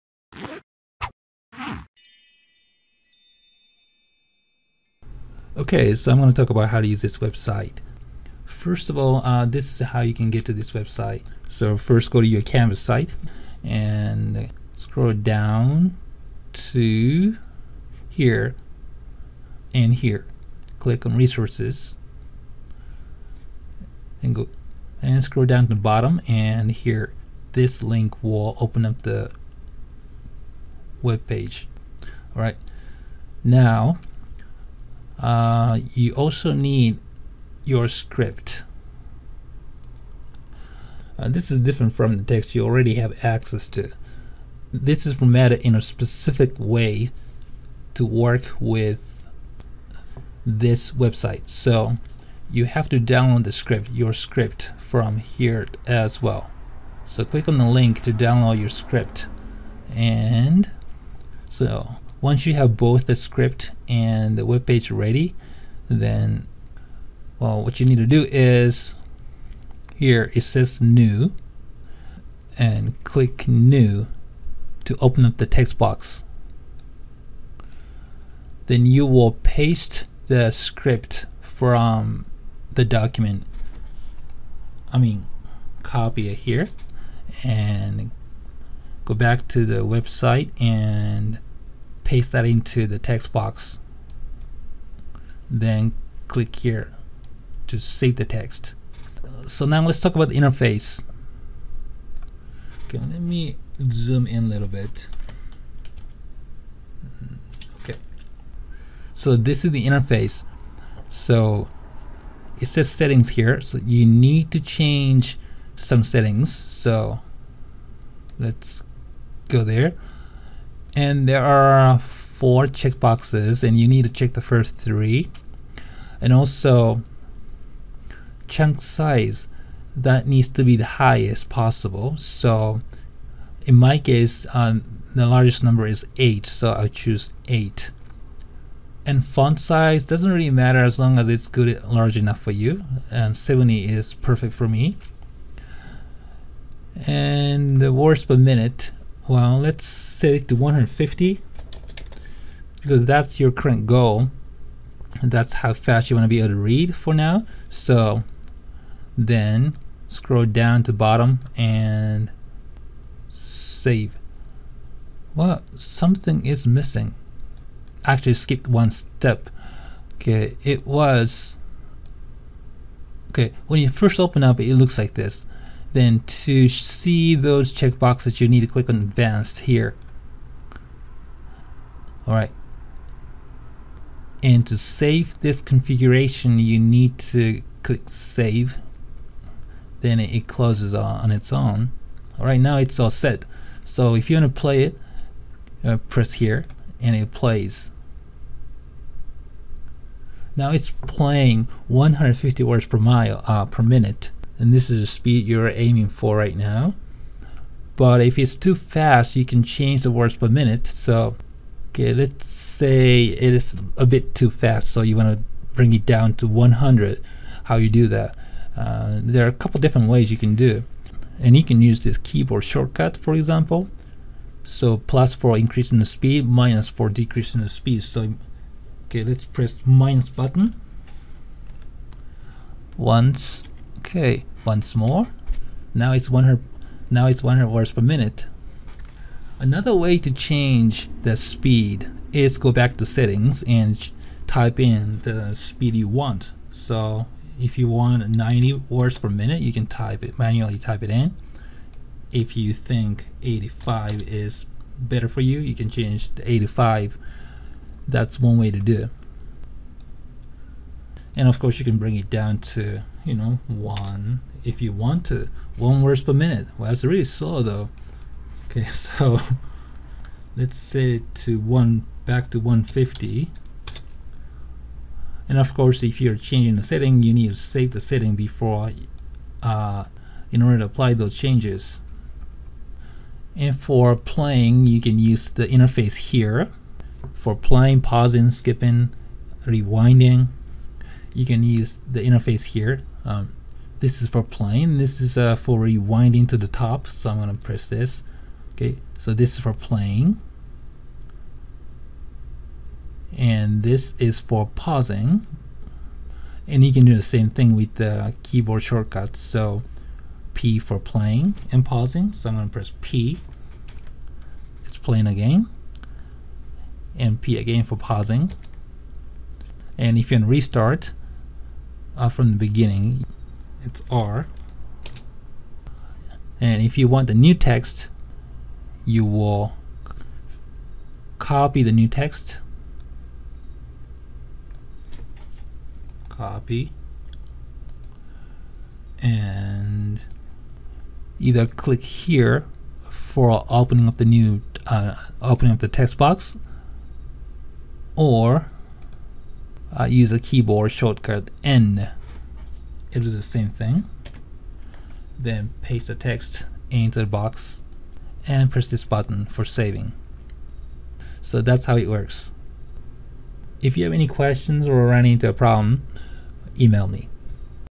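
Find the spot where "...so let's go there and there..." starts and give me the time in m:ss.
1:56.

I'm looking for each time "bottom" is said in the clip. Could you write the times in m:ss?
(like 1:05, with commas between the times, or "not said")
0:25, 2:40.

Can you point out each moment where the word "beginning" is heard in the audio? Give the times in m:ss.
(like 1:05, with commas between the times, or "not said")
5:22.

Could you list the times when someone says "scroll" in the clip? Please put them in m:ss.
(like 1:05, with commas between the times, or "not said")
0:14, 0:25, 2:40.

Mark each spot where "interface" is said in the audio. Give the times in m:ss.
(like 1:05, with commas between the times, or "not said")
1:40, 1:49, 4:45, 4:52.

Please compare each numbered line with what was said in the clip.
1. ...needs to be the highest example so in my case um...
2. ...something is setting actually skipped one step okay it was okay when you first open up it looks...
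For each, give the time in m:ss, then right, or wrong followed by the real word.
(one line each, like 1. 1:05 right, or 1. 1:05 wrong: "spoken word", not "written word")
1. 2:10 wrong: "possible", not "example"
2. 2:45 wrong: "missing", not "setting".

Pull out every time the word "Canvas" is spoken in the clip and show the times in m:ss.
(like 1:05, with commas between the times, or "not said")
0:12.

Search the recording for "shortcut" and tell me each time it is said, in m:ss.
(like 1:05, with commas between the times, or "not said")
3:42, 5:08, 5:50.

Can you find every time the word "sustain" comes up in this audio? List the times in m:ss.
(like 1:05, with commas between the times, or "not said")
not said.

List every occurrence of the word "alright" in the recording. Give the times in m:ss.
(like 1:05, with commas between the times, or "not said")
3:02, 3:12.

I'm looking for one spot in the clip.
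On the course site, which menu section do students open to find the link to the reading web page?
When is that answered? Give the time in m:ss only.
0:21.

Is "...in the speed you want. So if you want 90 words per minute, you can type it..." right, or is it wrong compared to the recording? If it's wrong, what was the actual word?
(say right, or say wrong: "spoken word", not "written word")
right.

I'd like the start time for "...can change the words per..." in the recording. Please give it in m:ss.
3:29.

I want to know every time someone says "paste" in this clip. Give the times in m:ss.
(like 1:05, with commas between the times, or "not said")
1:19, 1:32, 5:55.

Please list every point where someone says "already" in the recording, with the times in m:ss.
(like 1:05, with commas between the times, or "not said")
0:42.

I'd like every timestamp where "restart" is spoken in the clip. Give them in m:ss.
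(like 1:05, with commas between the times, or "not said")
5:20.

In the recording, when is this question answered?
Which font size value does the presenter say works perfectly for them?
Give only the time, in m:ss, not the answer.
2:23.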